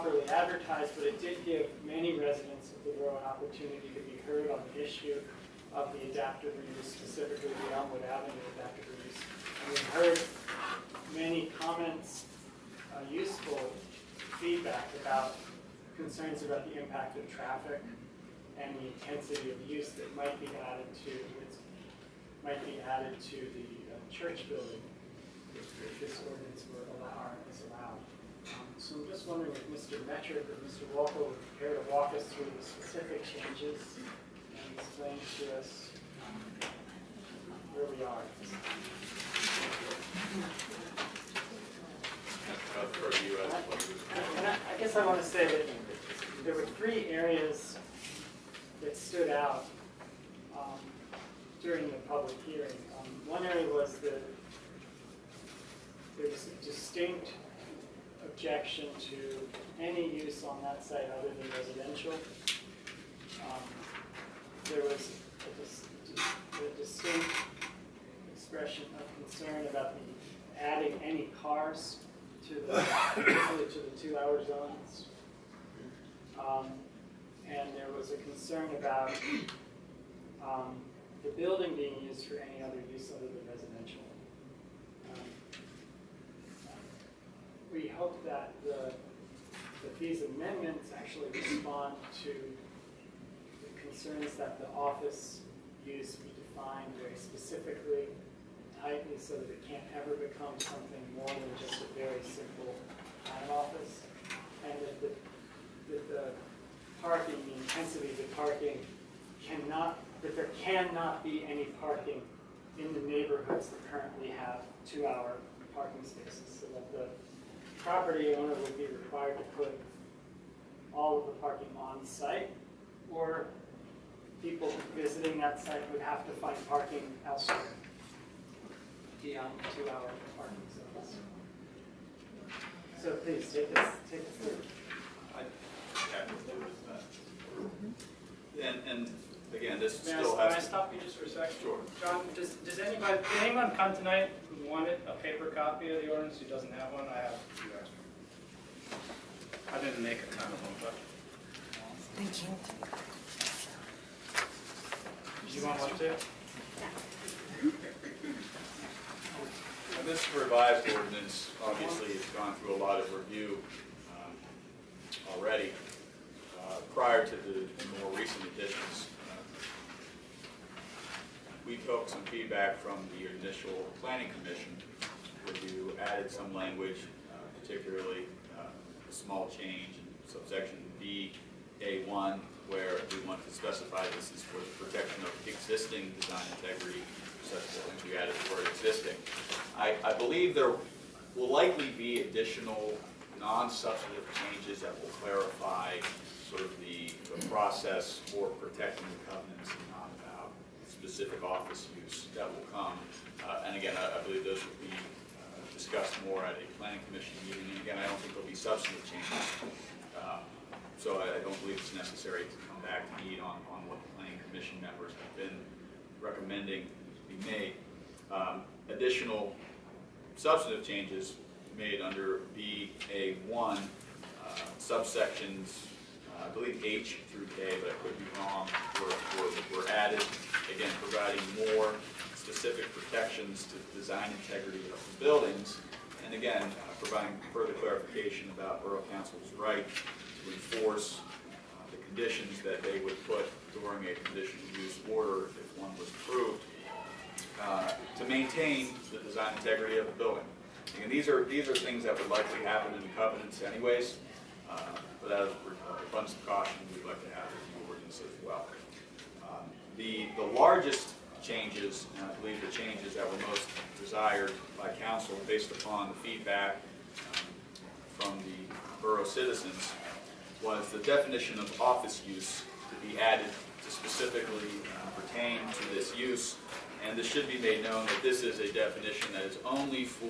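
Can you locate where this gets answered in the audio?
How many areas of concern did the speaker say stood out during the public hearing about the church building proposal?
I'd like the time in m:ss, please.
0:46.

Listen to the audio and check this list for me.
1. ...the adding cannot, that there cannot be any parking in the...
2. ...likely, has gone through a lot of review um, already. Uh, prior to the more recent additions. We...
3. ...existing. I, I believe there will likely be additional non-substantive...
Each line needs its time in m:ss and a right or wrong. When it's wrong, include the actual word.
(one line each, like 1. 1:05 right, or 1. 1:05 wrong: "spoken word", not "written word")
1. 1:48 wrong: "parking", not "adding"
2. 2:41 wrong: "obviously", not "likely"
3. 3:08 right.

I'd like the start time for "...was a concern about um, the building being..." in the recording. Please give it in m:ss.
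1:17.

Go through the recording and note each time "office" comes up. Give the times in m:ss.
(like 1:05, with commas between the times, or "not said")
1:34, 1:43, 3:21, 4:31.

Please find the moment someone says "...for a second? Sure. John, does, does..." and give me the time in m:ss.
2:21.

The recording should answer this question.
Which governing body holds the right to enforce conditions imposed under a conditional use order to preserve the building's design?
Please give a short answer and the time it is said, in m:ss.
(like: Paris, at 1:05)
Borough Council, at 3:58.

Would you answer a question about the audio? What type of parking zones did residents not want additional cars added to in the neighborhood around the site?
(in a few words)
two-hour zones.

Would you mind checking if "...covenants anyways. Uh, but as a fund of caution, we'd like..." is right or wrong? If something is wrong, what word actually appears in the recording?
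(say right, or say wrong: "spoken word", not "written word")
right.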